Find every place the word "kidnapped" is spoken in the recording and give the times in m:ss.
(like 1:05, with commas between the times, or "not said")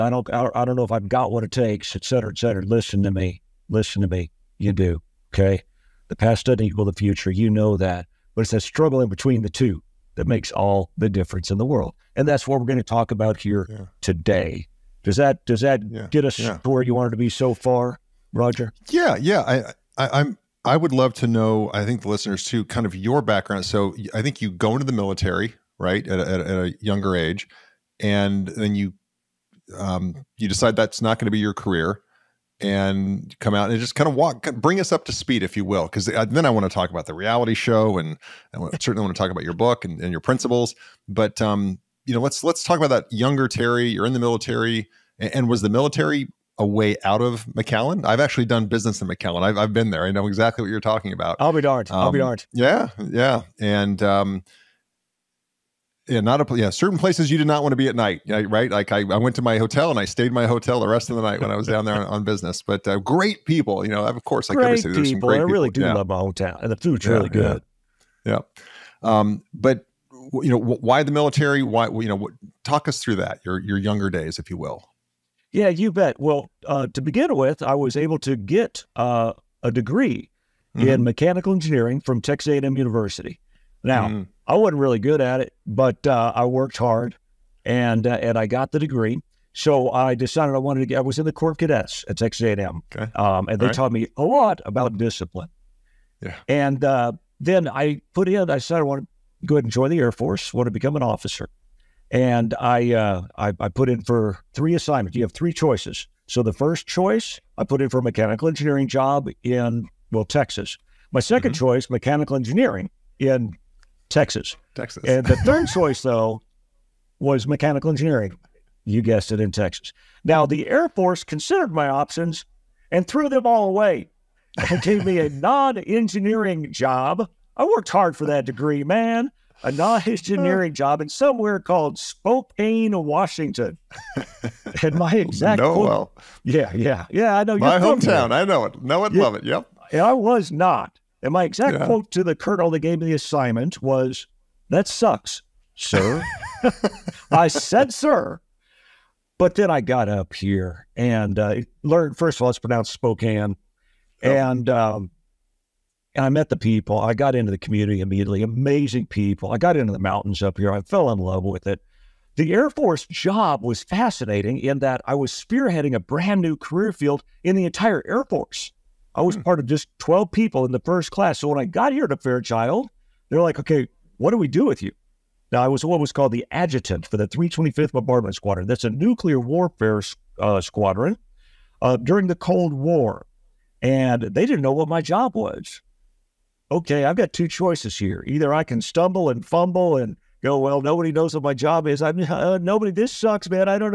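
not said.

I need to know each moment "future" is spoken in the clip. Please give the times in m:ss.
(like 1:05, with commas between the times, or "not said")
0:06.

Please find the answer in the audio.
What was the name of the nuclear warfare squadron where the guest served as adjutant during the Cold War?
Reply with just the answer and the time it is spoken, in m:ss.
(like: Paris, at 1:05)
325th Bombardment Squadron, at 2:57.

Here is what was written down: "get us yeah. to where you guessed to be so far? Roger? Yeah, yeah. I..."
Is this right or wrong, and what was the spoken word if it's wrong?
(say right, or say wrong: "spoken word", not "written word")
wrong: "wanted", not "guessed".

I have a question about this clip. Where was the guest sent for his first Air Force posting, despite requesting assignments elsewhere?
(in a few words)
Spokane, Washington.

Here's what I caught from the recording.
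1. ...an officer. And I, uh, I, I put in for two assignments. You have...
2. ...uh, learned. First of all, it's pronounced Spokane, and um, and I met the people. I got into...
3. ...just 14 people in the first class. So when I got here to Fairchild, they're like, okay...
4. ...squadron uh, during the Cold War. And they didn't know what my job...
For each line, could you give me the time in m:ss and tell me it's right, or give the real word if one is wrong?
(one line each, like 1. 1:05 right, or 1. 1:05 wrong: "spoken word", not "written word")
1. 1:40 wrong: "three", not "two"
2. 2:31 right
3. 2:49 wrong: "12", not "14"
4. 3:00 right.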